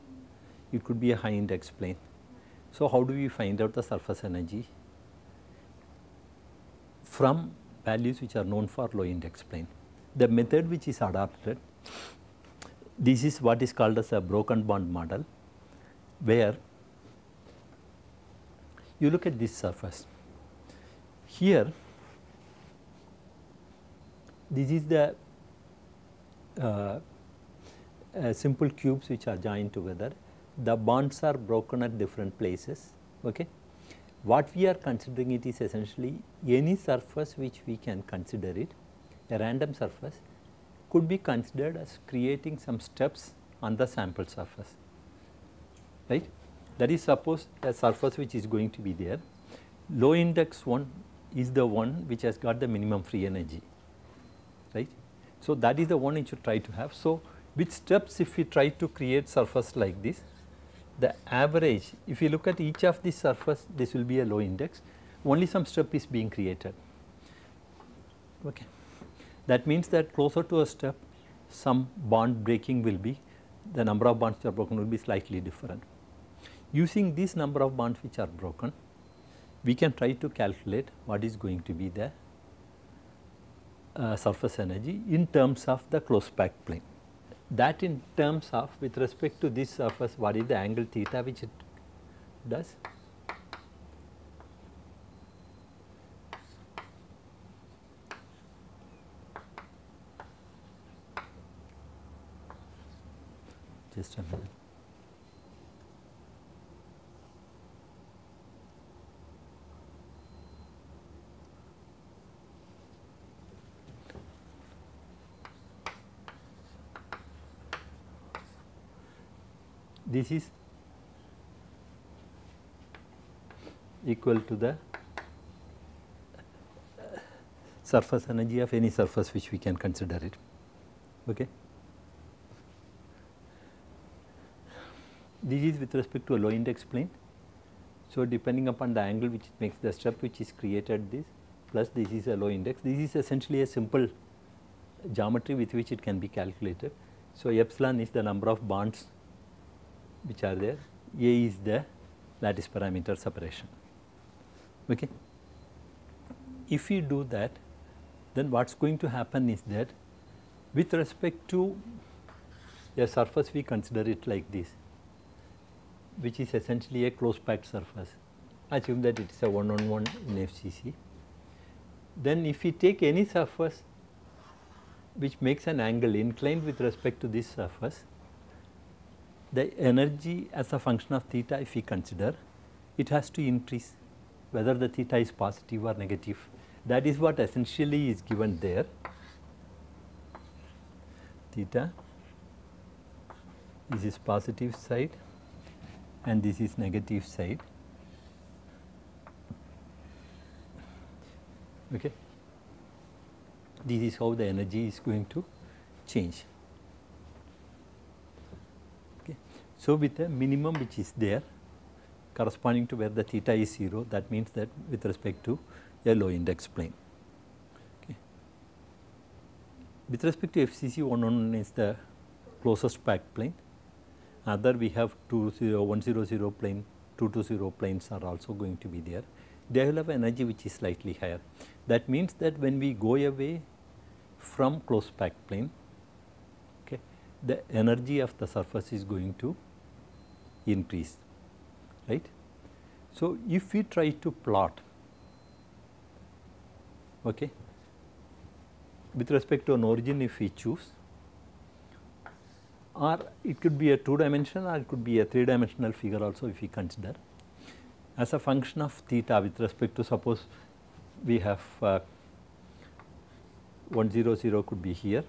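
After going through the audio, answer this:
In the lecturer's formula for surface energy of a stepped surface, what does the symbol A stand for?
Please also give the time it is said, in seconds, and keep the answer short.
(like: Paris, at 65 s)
lattice parameter separation, at 152 s.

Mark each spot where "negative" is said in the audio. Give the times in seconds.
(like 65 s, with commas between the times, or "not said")
185 s, 196 s.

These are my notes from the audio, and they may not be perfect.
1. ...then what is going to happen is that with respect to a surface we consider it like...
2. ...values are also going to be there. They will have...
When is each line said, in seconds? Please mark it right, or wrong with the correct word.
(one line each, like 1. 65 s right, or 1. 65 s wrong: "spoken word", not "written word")
1. 158 s right
2. 227 s wrong: "planes", not "values".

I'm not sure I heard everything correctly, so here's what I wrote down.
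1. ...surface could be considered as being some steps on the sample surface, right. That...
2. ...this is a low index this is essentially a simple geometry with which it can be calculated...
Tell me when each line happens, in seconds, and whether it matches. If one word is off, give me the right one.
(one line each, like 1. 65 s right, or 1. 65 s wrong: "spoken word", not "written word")
1. 39 s wrong: "creating", not "being"
2. 141 s right.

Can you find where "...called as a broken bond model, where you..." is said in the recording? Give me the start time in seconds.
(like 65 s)
13 s.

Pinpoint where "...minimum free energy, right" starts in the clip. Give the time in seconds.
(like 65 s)
52 s.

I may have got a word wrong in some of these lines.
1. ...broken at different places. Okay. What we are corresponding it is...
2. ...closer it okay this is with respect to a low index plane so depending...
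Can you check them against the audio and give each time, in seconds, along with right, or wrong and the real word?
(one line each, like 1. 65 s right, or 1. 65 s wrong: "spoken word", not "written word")
1. 31 s wrong: "considering", not "corresponding"
2. 129 s wrong: "consider", not "closer".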